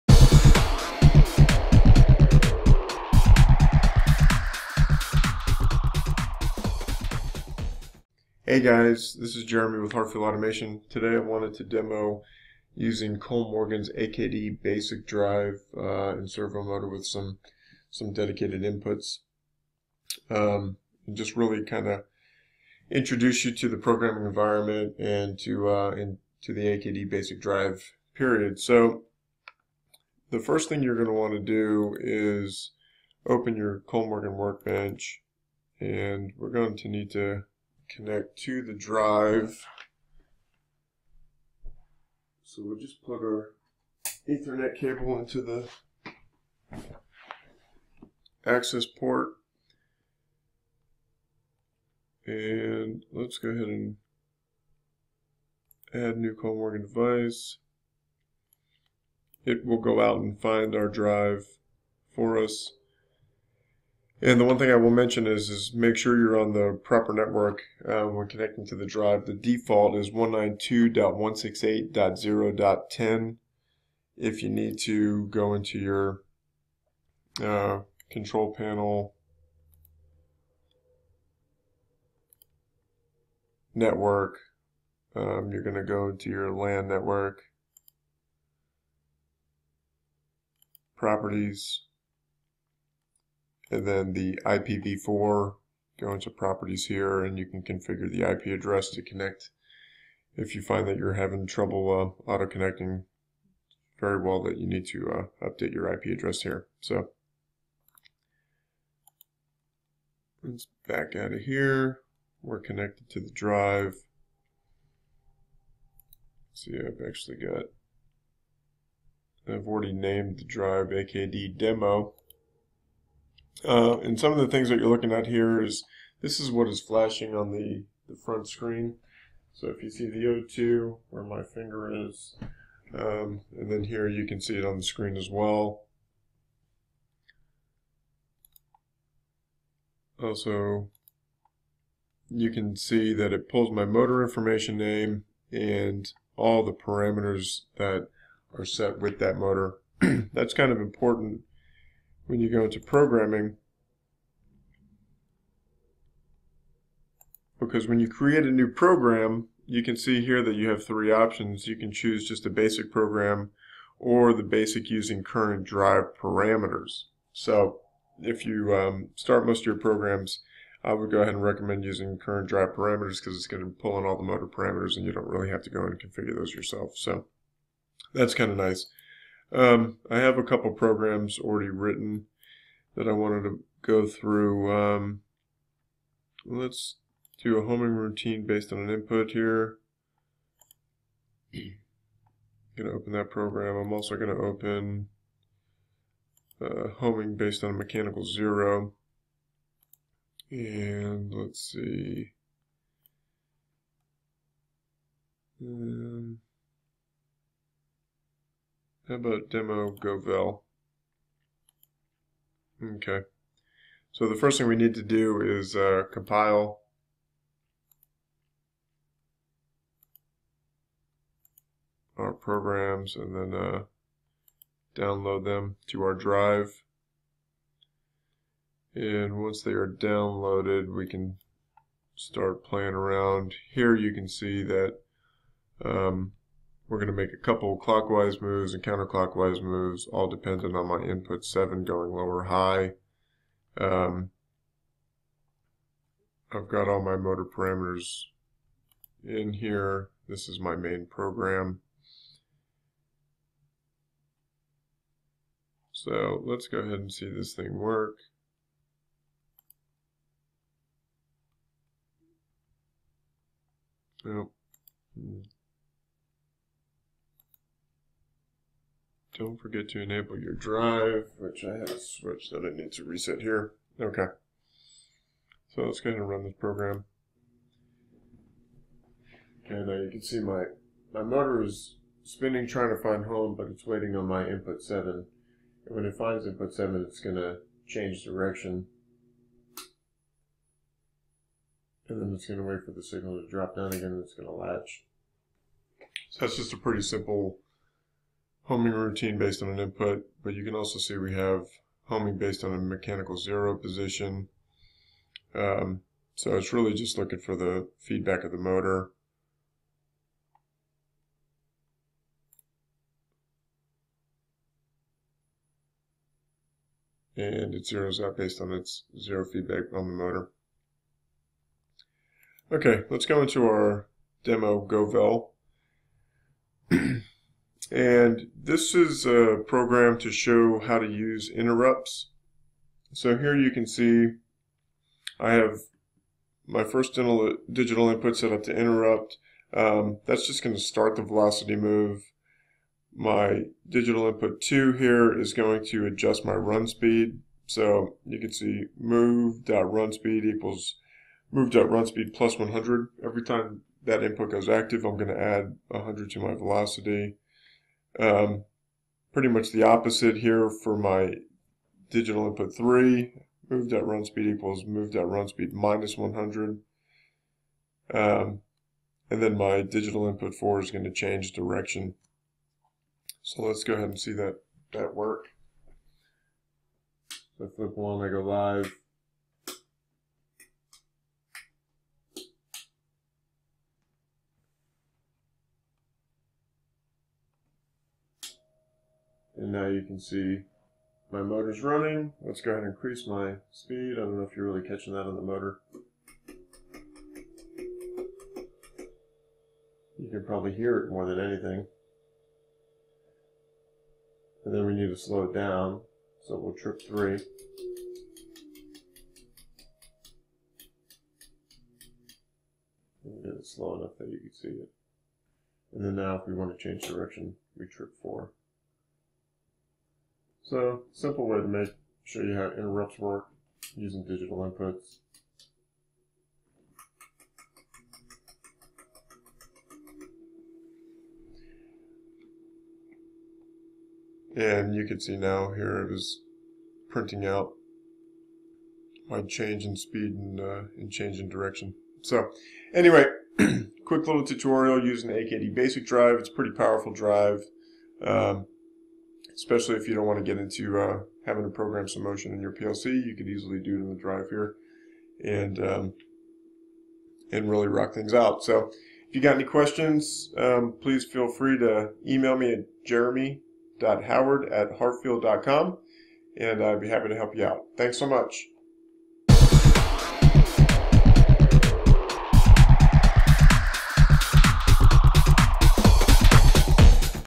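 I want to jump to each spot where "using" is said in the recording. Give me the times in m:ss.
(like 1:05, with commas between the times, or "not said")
0:12, 2:44, 2:51, 7:03, 7:25.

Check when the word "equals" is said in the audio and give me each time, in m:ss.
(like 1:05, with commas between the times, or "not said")
5:50, 6:04.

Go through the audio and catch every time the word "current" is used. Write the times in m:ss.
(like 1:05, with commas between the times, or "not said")
2:45, 2:52.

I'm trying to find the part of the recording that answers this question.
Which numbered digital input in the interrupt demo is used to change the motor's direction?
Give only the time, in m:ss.
6:09.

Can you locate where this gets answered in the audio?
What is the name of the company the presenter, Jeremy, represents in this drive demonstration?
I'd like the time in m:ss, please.
0:09.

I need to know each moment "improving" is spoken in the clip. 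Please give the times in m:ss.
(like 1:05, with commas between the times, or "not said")
not said.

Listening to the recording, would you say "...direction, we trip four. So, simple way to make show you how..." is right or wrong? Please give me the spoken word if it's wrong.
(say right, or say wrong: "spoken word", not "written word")
right.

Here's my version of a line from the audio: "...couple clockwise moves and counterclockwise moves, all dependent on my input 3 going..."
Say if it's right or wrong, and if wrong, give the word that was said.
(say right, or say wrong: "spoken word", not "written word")
wrong: "7", not "3".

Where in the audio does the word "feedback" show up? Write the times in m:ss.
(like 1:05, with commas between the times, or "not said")
5:07, 5:19.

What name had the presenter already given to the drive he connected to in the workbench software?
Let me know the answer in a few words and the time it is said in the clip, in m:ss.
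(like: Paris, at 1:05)
AKD demo, at 2:00.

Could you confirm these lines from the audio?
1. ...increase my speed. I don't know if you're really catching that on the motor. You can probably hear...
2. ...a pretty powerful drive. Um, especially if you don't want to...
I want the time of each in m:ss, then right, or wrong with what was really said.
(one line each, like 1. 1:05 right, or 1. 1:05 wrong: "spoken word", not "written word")
1. 6:32 right
2. 7:26 right.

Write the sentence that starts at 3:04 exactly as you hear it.
Um, let's do a homing routine based on an input here.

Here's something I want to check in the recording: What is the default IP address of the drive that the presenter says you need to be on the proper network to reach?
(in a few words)
192.168.0.10.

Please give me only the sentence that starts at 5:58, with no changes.
Um, pretty much the opposite here for my digital input 3.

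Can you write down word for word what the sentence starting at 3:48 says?
And once they are downloaded, we can start playing around.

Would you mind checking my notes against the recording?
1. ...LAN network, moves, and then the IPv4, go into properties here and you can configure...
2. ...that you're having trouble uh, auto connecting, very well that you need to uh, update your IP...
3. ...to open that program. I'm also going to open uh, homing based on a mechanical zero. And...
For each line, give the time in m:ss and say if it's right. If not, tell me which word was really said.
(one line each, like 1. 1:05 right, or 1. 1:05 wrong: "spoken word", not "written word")
1. 1:26 wrong: "properties", not "moves"
2. 1:40 right
3. 3:12 right.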